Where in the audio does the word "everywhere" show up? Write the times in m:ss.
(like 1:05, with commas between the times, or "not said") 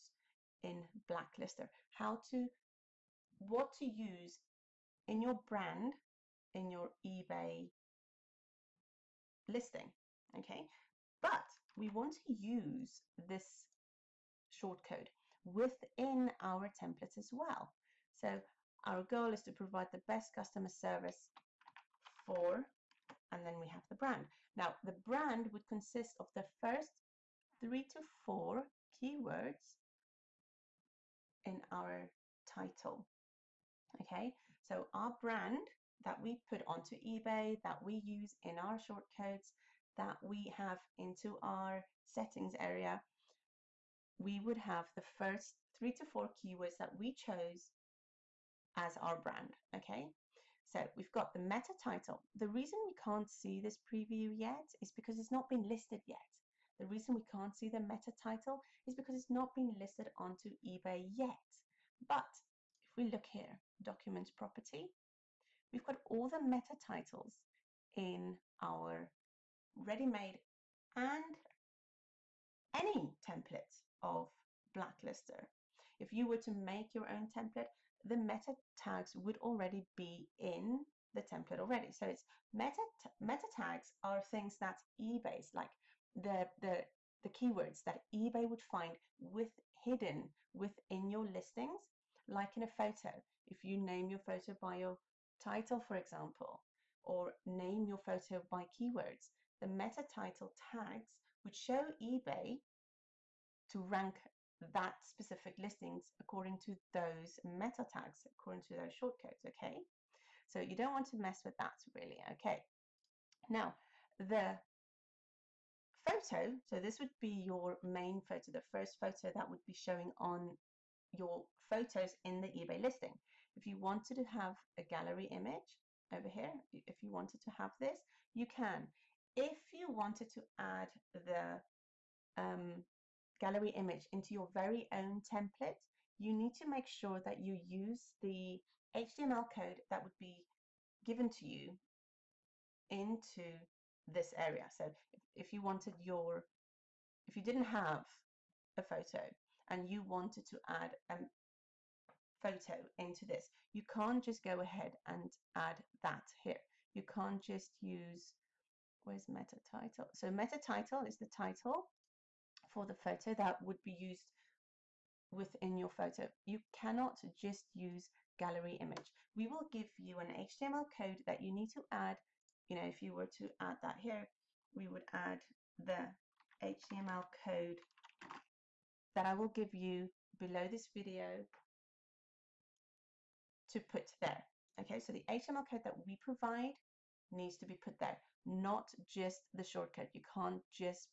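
not said.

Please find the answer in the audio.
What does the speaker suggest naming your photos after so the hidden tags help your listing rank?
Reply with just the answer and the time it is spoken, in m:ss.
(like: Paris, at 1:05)
Your title, at 1:34.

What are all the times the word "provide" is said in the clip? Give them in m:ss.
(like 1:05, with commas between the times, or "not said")
0:19, 3:06.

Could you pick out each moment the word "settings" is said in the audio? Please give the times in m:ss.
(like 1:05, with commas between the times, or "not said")
0:42.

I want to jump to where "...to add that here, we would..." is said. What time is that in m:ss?
2:53.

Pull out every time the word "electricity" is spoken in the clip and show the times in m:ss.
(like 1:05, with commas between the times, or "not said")
not said.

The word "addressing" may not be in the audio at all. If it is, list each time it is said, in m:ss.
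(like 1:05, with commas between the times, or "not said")
not said.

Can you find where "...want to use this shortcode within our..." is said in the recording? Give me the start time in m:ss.
0:11.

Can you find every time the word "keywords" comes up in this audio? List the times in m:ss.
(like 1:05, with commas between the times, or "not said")
0:28, 0:46, 1:27, 1:38.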